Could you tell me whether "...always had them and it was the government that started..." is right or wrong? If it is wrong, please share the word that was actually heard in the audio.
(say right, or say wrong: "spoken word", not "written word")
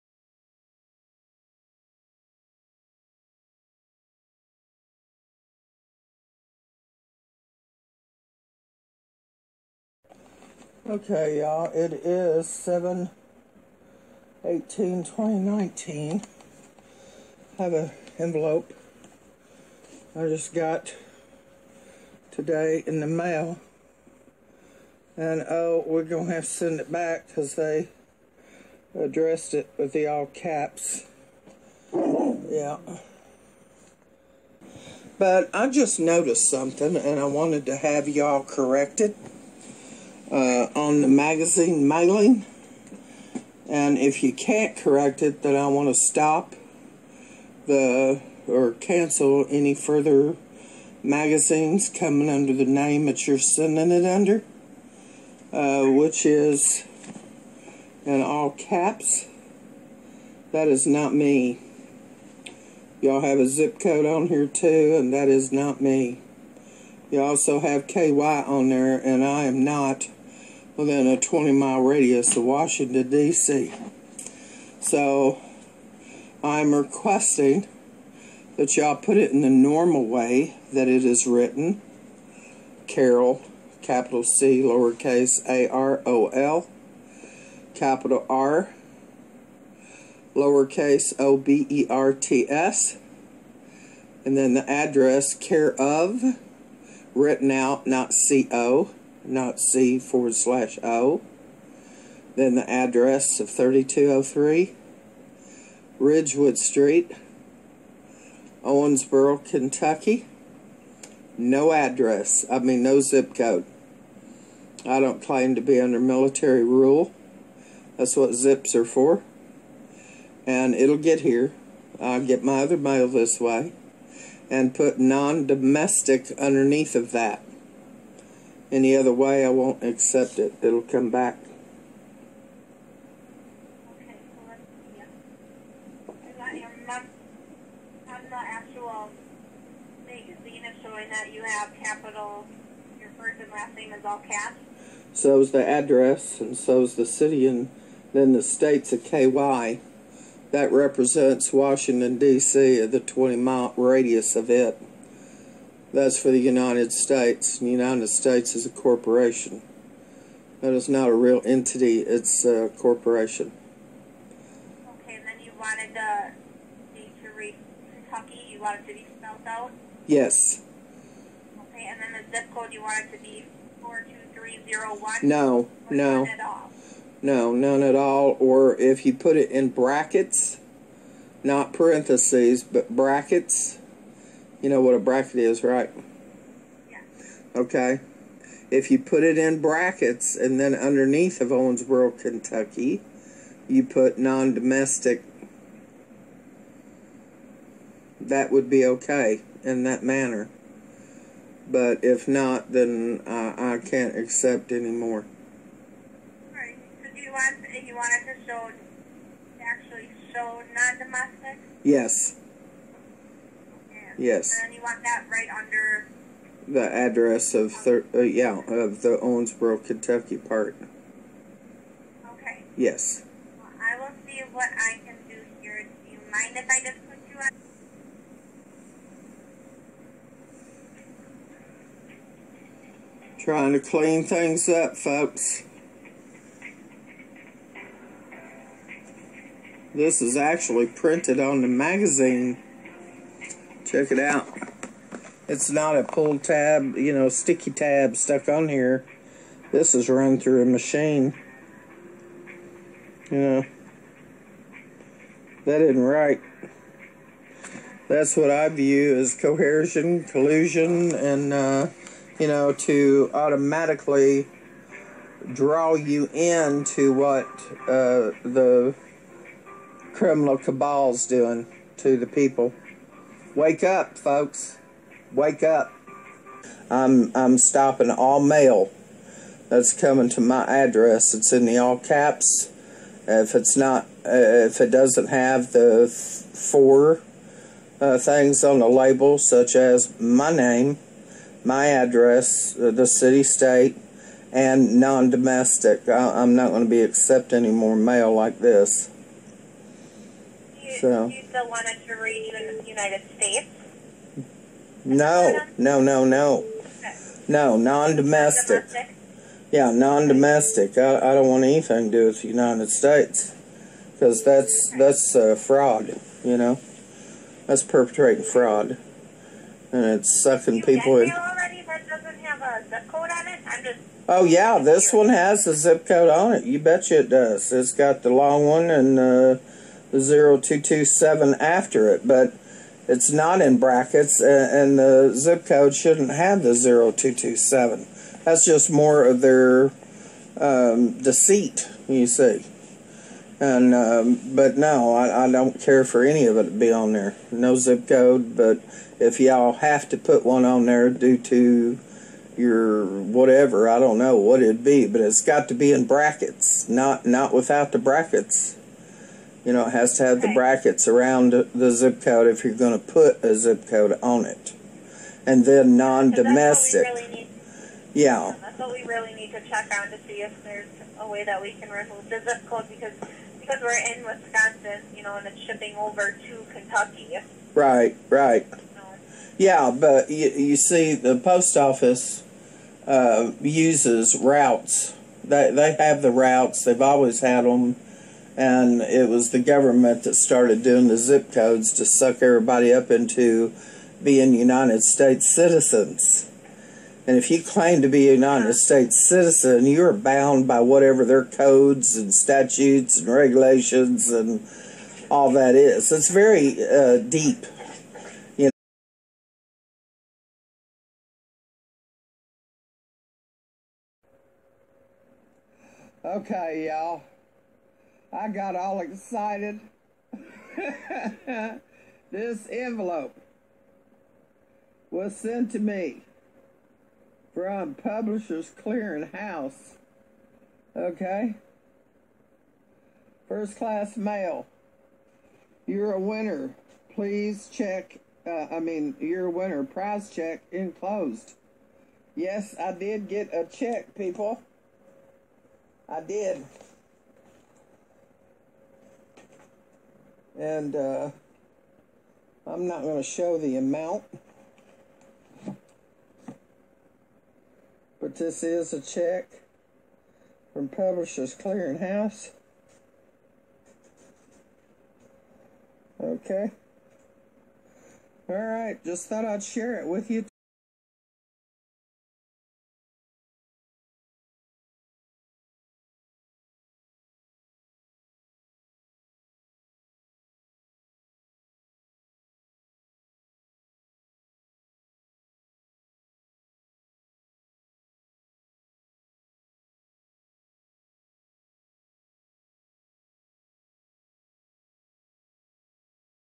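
right.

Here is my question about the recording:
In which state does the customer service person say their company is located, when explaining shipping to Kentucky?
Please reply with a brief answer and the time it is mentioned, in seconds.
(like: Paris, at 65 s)
Wisconsin, at 374 s.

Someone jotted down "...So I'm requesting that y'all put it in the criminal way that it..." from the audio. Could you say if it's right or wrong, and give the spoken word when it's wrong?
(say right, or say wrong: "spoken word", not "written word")
wrong: "normal", not "criminal".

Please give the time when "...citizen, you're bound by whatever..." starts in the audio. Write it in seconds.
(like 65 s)
399 s.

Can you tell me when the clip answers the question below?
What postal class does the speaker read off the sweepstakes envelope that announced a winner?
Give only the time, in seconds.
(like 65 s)
433 s.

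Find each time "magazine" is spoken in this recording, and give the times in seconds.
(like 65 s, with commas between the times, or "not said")
41 s, 51 s, 241 s.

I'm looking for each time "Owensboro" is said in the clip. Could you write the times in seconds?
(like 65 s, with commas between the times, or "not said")
108 s, 191 s, 219 s.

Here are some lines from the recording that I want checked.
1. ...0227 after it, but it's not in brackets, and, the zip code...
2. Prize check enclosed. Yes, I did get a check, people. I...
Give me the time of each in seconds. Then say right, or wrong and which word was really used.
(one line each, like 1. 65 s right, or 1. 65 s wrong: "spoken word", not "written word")
1. 330 s right
2. 439 s right.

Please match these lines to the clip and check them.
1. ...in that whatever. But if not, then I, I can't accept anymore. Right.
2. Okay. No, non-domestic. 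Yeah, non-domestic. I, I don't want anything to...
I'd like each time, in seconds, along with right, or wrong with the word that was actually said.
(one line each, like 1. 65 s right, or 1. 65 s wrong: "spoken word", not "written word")
1. 199 s wrong: "manner", not "whatever"
2. 306 s right.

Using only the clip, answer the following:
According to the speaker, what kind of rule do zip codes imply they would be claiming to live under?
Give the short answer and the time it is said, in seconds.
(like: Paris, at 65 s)
military rule, at 115 s.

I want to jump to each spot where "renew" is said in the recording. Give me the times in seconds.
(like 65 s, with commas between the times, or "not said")
302 s.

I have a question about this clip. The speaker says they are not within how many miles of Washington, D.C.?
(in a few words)
20 mile.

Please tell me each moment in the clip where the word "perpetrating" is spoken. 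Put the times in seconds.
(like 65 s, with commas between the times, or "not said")
317 s.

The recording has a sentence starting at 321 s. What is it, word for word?
Already that doesn't have a zip code on it.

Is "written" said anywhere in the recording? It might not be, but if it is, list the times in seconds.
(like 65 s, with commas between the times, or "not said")
81 s, 97 s.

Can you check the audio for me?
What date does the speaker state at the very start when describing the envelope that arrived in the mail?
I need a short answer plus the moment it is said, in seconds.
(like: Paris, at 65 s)
7/18/2019, at 12 s.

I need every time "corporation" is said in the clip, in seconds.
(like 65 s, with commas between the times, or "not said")
158 s, 162 s.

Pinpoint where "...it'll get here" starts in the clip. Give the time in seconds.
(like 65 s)
120 s.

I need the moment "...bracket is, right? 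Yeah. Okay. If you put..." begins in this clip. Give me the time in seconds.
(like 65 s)
184 s.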